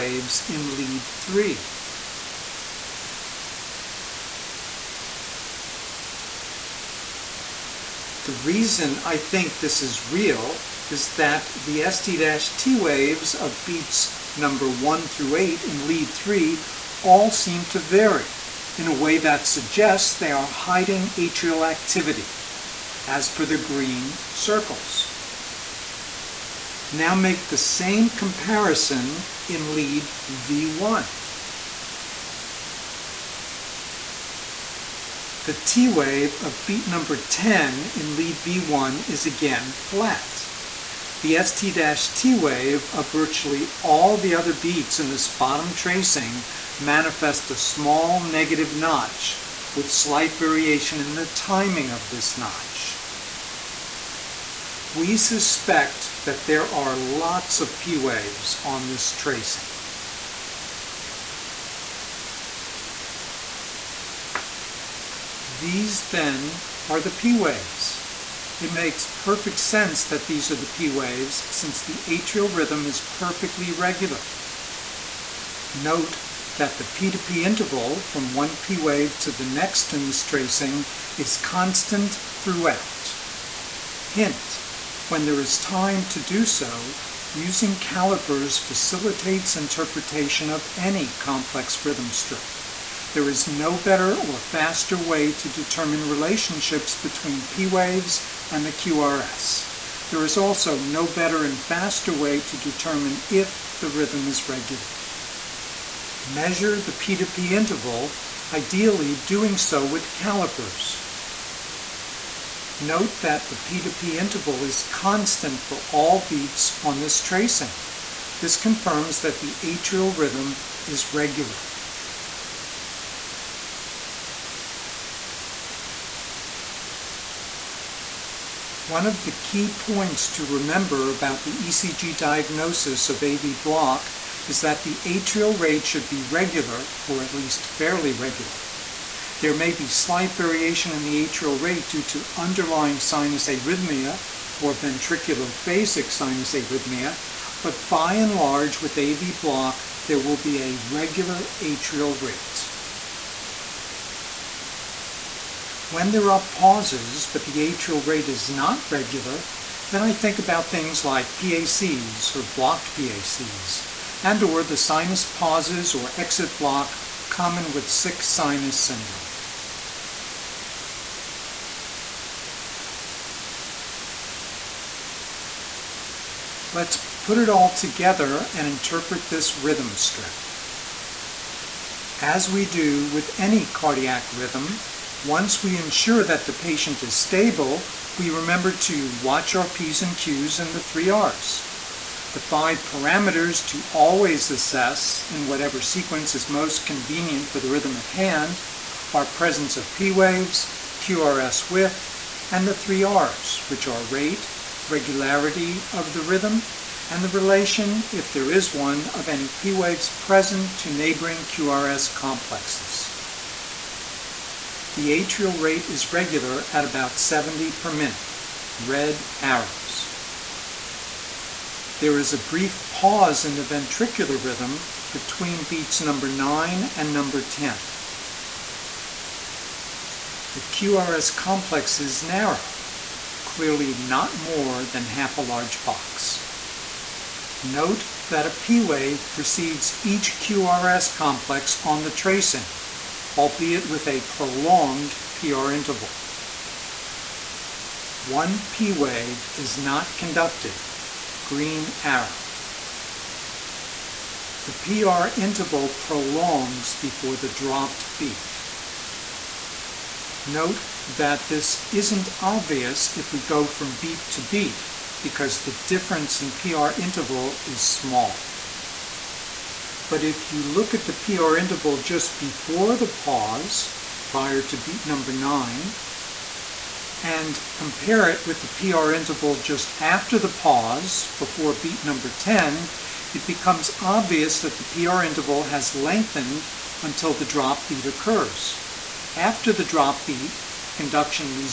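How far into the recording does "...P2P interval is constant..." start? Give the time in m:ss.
1:53.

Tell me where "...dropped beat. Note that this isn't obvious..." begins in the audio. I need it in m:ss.
4:17.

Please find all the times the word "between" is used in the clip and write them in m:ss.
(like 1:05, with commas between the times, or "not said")
1:36, 3:45.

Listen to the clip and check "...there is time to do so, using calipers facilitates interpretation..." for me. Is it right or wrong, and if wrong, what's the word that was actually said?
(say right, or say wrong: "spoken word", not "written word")
right.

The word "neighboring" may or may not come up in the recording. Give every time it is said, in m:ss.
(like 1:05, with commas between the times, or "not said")
3:30.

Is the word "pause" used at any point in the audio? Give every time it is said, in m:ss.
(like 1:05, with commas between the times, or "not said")
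2:36, 2:45, 3:42, 4:33, 4:40.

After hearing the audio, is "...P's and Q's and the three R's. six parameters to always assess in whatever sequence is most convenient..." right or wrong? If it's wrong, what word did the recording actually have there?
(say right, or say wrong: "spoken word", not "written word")
wrong: "five", not "six".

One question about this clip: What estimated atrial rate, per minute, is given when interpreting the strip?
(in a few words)
70.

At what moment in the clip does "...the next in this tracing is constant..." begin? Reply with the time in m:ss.
1:19.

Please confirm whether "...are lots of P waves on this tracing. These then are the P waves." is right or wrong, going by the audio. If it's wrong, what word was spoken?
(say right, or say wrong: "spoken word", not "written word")
right.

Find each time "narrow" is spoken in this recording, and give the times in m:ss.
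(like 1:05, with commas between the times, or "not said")
3:52.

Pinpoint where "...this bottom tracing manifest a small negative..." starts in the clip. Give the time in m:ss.
0:45.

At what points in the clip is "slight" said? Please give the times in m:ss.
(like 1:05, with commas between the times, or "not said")
0:49, 2:19.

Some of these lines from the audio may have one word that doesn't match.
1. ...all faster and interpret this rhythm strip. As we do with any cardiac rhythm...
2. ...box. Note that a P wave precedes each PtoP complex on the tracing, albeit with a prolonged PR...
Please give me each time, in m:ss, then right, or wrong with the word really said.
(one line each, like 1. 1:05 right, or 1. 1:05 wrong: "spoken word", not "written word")
1. 2:57 wrong: "together", not "faster"
2. 3:55 wrong: "QRS", not "PtoP".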